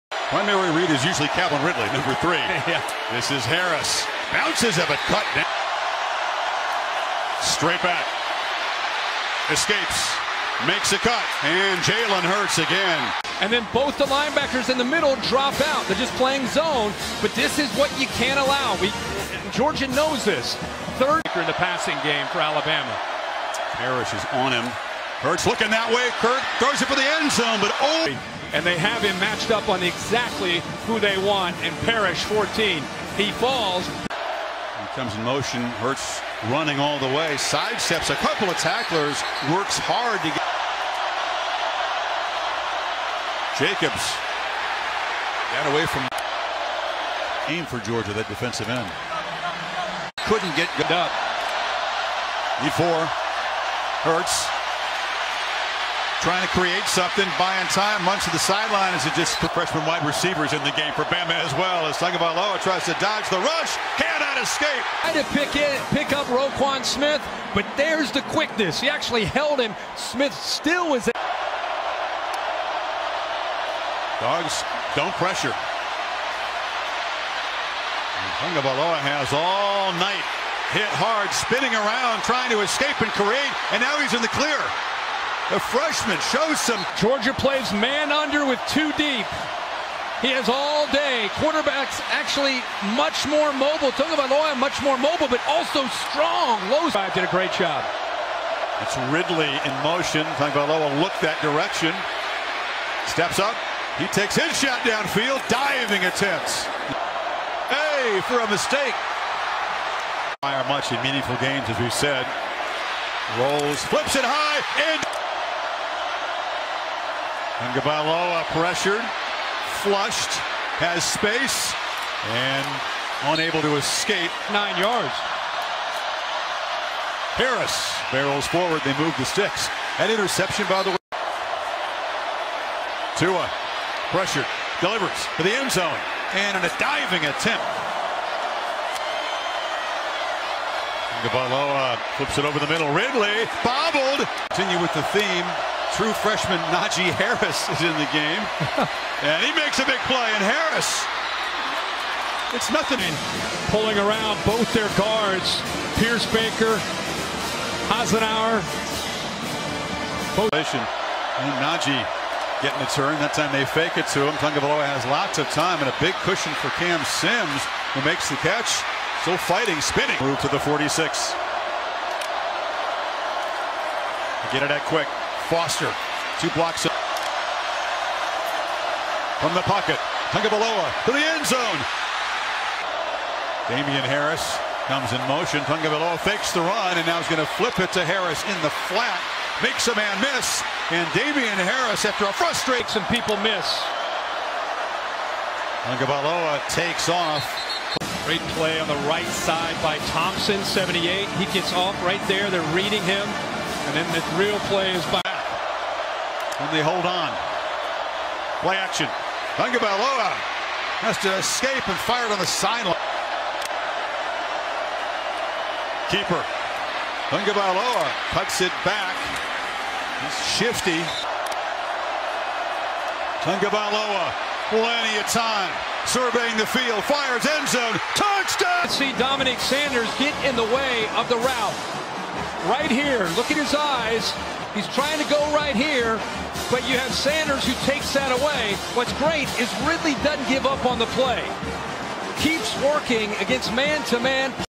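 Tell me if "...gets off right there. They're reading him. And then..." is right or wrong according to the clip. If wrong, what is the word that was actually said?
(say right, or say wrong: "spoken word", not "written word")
right.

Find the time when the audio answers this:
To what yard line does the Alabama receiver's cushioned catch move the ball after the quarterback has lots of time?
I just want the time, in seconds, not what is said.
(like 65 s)
170 s.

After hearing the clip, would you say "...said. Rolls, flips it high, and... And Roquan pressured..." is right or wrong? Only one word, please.
wrong.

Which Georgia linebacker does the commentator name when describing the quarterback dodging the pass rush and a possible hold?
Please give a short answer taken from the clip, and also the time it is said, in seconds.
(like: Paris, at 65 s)
Roquan Smith, at 66 s.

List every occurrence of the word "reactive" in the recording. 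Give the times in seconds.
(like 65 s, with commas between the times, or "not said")
not said.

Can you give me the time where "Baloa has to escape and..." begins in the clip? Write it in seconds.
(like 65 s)
209 s.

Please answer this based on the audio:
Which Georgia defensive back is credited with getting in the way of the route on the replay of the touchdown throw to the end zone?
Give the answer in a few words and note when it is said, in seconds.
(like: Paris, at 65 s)
Dominick Sanders, at 229 s.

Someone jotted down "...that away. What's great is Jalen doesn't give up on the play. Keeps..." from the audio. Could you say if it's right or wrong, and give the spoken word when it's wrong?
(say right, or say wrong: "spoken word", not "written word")
wrong: "Ridley", not "Jalen".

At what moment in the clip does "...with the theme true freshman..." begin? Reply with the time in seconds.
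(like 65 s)
144 s.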